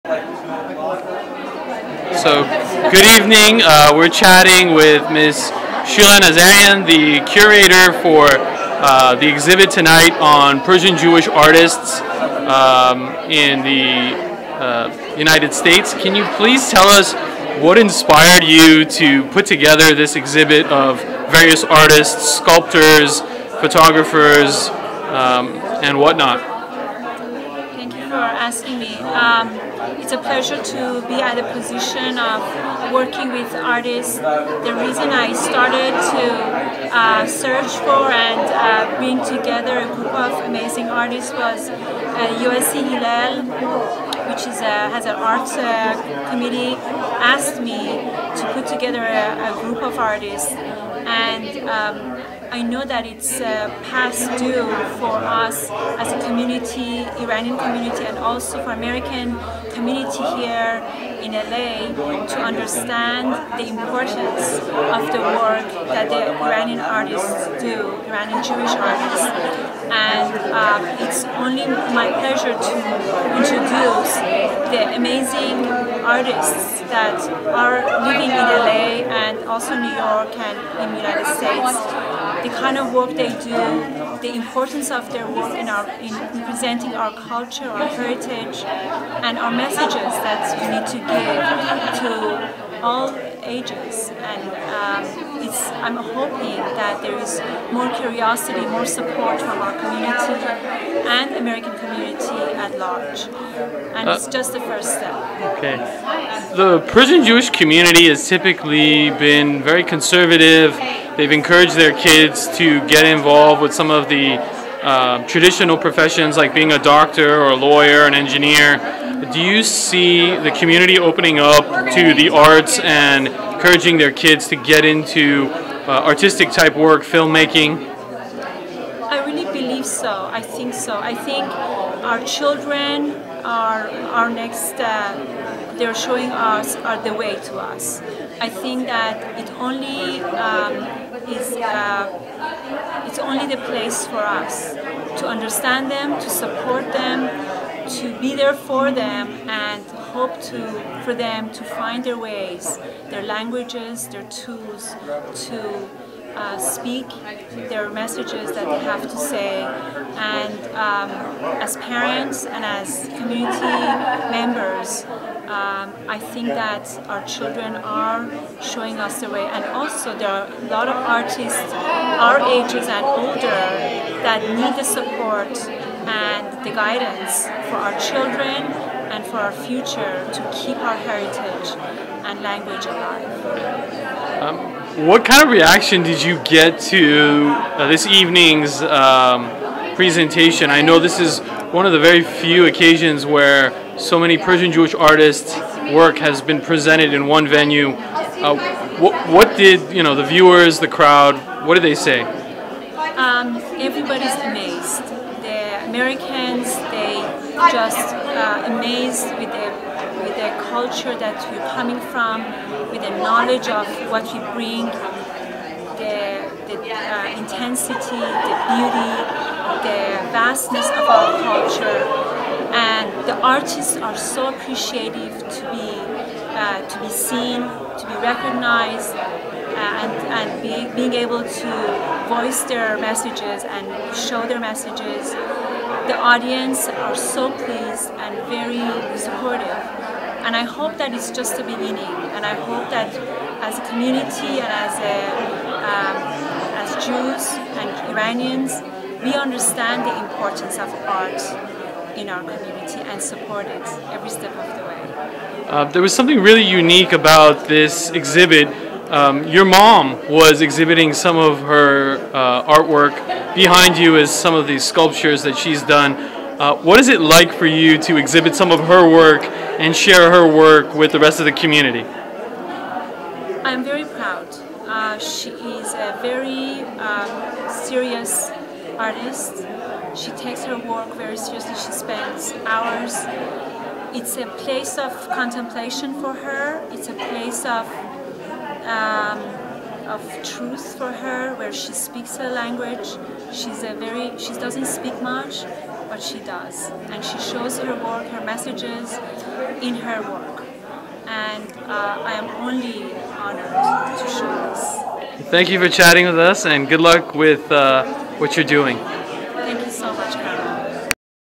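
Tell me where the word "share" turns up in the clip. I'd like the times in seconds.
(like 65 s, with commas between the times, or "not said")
269 s.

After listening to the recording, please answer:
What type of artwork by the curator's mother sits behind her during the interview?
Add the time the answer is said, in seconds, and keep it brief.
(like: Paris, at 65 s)
sculptures, at 264 s.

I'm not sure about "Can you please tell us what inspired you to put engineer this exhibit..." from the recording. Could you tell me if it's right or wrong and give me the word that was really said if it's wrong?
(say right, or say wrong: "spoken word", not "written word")
wrong: "together", not "engineer".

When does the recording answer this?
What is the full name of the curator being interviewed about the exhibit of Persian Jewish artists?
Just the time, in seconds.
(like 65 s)
5 s.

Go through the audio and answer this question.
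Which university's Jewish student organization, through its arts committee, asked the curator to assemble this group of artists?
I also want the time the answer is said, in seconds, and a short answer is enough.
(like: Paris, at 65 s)
USC Hillel, at 42 s.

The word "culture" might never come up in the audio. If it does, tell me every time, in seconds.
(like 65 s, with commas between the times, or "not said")
87 s, 210 s, 221 s.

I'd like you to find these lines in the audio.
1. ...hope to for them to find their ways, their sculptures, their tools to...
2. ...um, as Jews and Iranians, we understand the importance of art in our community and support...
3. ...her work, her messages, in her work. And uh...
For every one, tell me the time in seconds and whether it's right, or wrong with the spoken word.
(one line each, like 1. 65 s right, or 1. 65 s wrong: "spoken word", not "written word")
1. 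150 s wrong: "languages", not "sculptures"
2. 245 s right
3. 297 s right.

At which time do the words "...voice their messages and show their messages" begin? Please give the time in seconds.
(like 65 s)
232 s.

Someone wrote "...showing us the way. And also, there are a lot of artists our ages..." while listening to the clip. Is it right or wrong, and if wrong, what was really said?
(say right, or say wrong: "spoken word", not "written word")
right.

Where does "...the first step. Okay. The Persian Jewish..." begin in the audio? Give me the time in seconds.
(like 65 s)
104 s.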